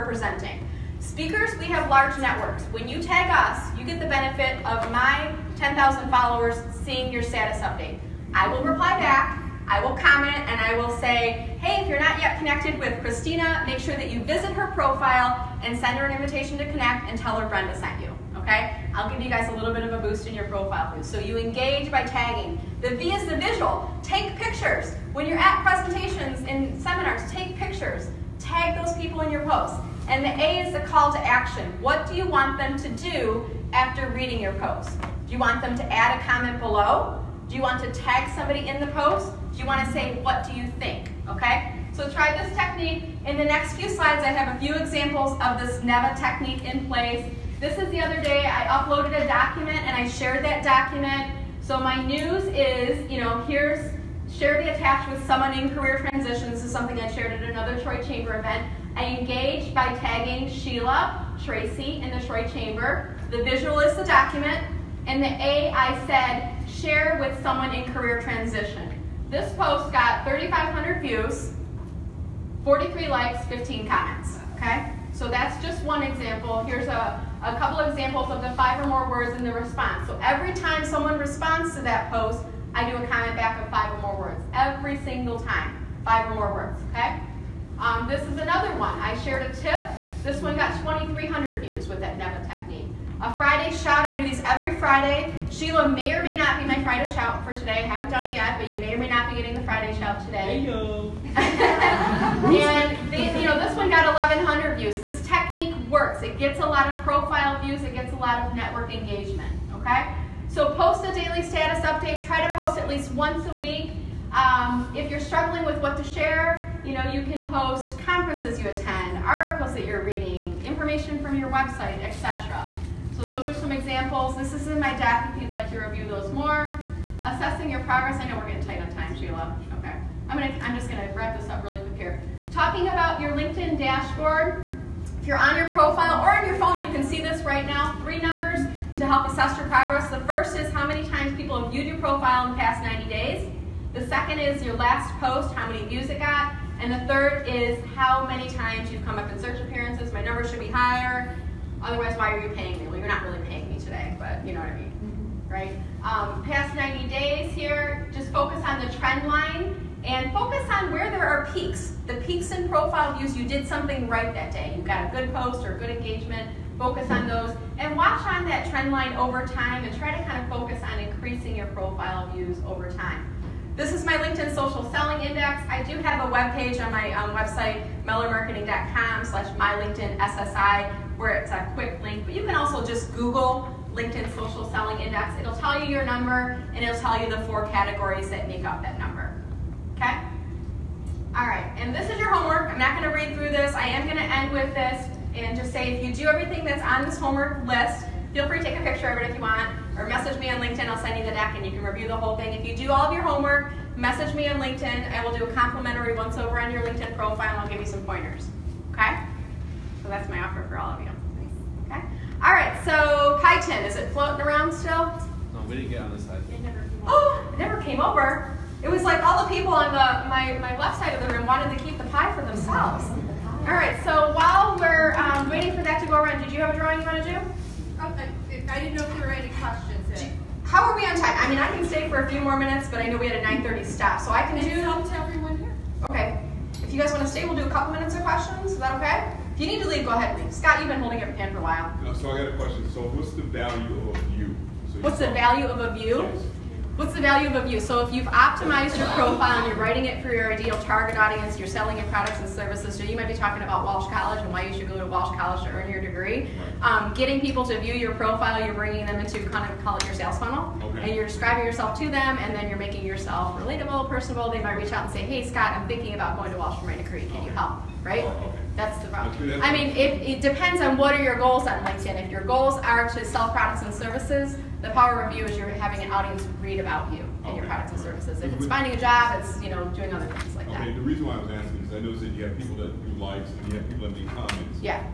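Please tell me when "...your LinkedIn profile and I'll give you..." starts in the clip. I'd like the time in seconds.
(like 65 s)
206 s.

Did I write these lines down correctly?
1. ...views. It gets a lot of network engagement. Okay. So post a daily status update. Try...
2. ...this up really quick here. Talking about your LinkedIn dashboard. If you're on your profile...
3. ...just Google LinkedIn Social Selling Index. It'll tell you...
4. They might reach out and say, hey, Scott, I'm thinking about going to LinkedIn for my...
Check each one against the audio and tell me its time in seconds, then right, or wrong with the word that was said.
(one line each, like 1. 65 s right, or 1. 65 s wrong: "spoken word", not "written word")
1. 107 s right
2. 131 s right
3. 182 s right
4. 264 s wrong: "Walsh", not "LinkedIn".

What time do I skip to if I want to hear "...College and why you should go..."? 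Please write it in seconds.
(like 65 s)
254 s.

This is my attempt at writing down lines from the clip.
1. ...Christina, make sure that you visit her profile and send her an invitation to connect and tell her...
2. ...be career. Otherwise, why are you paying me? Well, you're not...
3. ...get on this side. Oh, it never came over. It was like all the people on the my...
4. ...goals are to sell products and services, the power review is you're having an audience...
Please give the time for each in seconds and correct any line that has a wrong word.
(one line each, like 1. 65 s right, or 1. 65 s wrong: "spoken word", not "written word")
1. 12 s right
2. 150 s wrong: "higher", not "career"
3. 215 s right
4. 272 s right.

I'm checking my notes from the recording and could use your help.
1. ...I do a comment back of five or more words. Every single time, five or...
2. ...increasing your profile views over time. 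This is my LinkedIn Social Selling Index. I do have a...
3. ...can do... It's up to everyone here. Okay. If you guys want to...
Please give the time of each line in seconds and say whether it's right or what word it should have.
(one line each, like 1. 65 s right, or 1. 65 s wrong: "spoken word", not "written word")
1. 82 s right
2. 170 s right
3. 234 s right.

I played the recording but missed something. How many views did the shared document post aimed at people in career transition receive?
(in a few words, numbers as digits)
3,500.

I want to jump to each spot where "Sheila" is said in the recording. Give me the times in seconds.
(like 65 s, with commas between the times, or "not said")
60 s, 95 s, 129 s.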